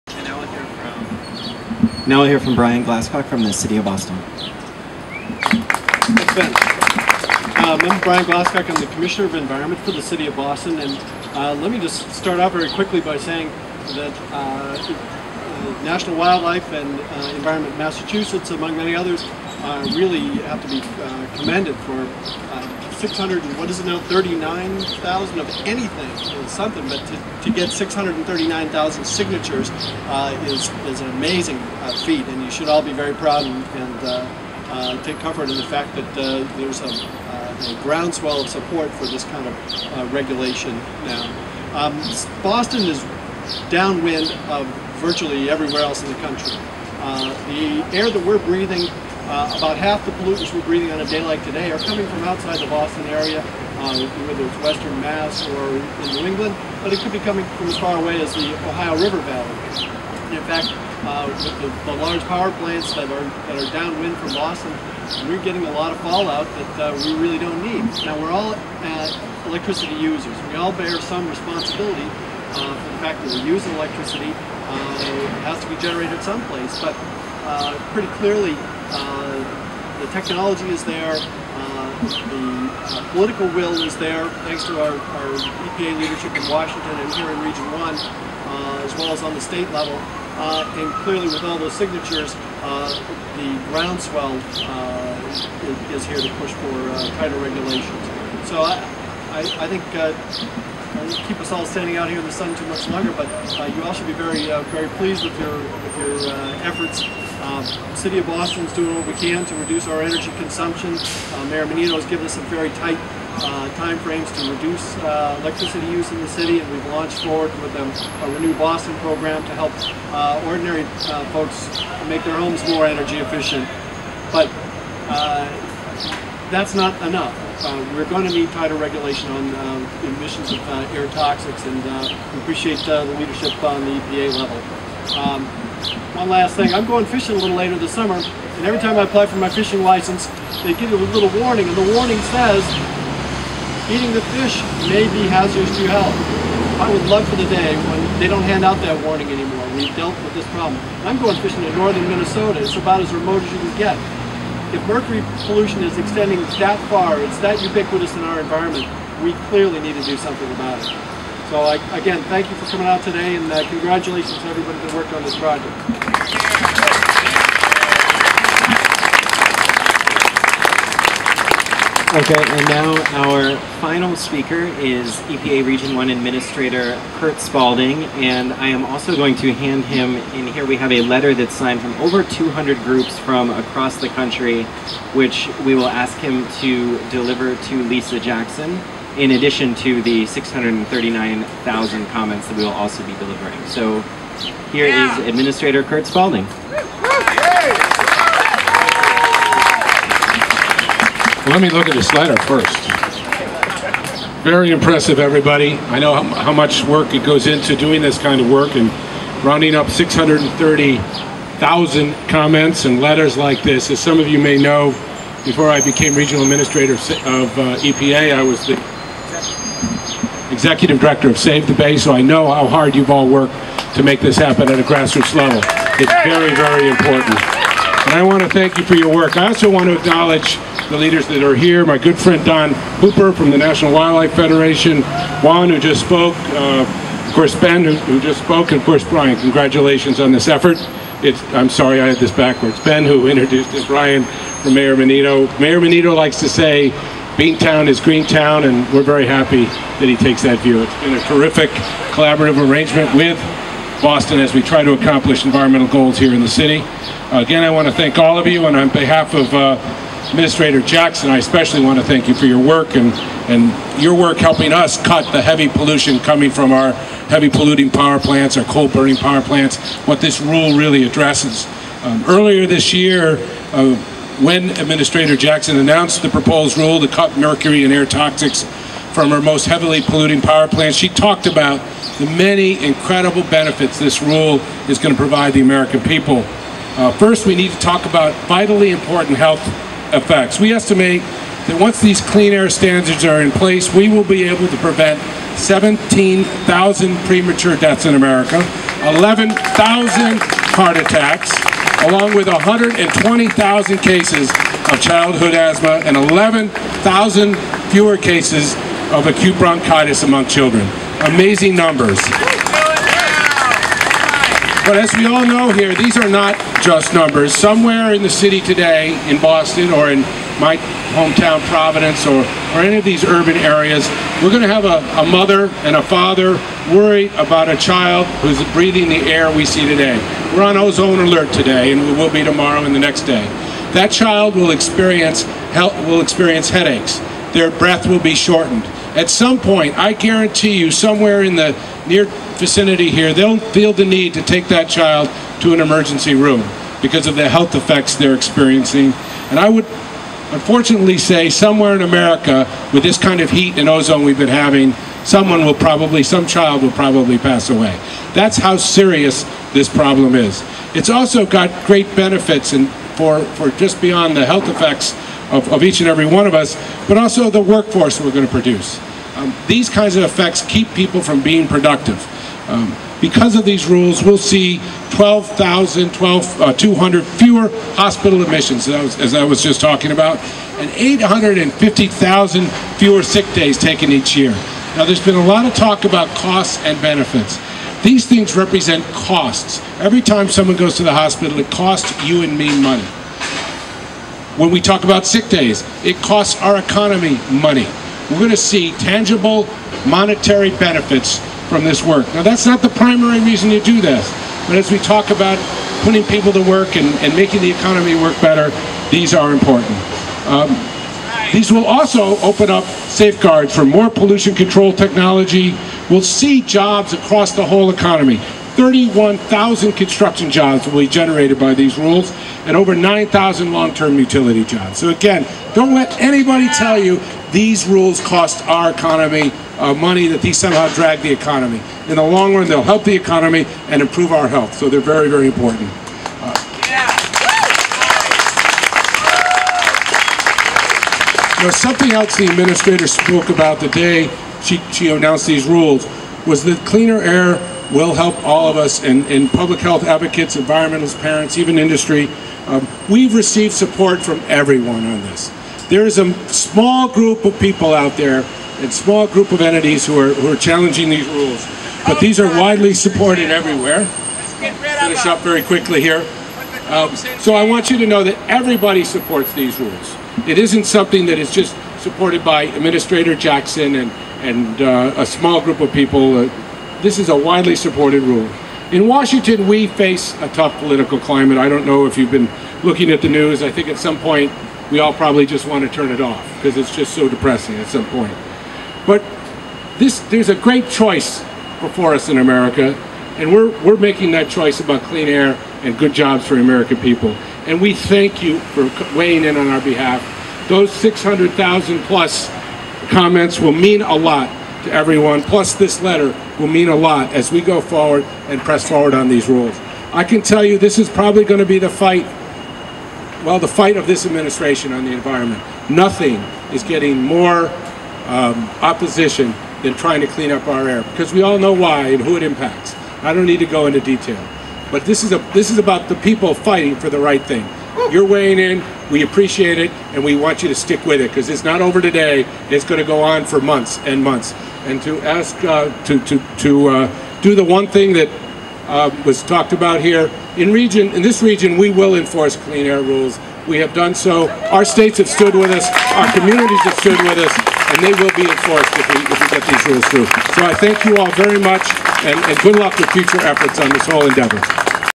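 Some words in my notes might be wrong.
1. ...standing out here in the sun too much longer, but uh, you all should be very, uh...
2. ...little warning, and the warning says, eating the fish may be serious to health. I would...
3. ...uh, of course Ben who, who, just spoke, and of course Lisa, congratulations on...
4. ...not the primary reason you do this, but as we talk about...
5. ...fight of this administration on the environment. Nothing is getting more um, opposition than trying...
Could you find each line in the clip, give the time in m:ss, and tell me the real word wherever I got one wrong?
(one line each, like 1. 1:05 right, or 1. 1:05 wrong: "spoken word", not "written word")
1. 1:41 right
2. 2:21 wrong: "hazardous", not "serious"
3. 3:56 wrong: "Brian", not "Lisa"
4. 6:42 right
5. 8:33 right.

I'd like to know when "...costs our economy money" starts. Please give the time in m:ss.
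6:36.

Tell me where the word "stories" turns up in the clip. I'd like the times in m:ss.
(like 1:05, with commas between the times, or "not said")
not said.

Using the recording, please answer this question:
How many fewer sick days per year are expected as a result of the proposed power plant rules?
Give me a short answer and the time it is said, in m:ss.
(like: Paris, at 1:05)
850,000, at 6:20.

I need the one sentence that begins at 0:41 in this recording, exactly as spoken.
Um, Boston is downwind of virtually everywhere else in the country.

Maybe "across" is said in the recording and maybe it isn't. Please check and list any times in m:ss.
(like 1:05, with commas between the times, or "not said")
3:03, 6:57.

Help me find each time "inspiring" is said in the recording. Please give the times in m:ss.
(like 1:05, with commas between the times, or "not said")
not said.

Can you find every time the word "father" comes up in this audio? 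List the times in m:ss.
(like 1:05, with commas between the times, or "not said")
5:26.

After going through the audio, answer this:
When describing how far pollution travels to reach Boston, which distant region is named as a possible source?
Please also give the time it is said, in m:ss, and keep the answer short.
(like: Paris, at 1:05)
Ohio River Valley, at 0:58.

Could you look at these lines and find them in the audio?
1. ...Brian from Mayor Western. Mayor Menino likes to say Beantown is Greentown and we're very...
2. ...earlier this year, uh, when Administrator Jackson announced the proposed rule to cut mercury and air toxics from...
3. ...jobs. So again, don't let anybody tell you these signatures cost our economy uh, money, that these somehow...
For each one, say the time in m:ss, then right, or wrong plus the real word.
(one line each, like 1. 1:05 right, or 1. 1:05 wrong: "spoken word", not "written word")
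1. 4:03 wrong: "Menino", not "Western"
2. 4:32 right
3. 7:04 wrong: "rules", not "signatures".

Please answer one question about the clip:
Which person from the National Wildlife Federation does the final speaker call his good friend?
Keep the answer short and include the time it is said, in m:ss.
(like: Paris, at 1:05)
Don Hooper, at 3:52.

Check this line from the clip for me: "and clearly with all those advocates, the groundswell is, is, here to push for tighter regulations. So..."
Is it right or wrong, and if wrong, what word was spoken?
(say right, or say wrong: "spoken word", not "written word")
wrong: "signatures", not "advocates".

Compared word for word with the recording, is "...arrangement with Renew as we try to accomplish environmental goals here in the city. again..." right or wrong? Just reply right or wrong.
wrong.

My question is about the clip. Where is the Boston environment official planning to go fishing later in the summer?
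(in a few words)
northern Minnesota.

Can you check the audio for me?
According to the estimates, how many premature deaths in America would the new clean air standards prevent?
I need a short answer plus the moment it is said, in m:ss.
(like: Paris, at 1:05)
17,000, at 4:55.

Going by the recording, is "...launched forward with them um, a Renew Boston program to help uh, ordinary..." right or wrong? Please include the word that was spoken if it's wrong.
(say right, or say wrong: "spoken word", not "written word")
right.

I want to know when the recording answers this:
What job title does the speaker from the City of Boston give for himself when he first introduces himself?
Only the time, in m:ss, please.
0:08.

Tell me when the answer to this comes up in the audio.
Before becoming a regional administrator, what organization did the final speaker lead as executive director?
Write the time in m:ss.
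3:41.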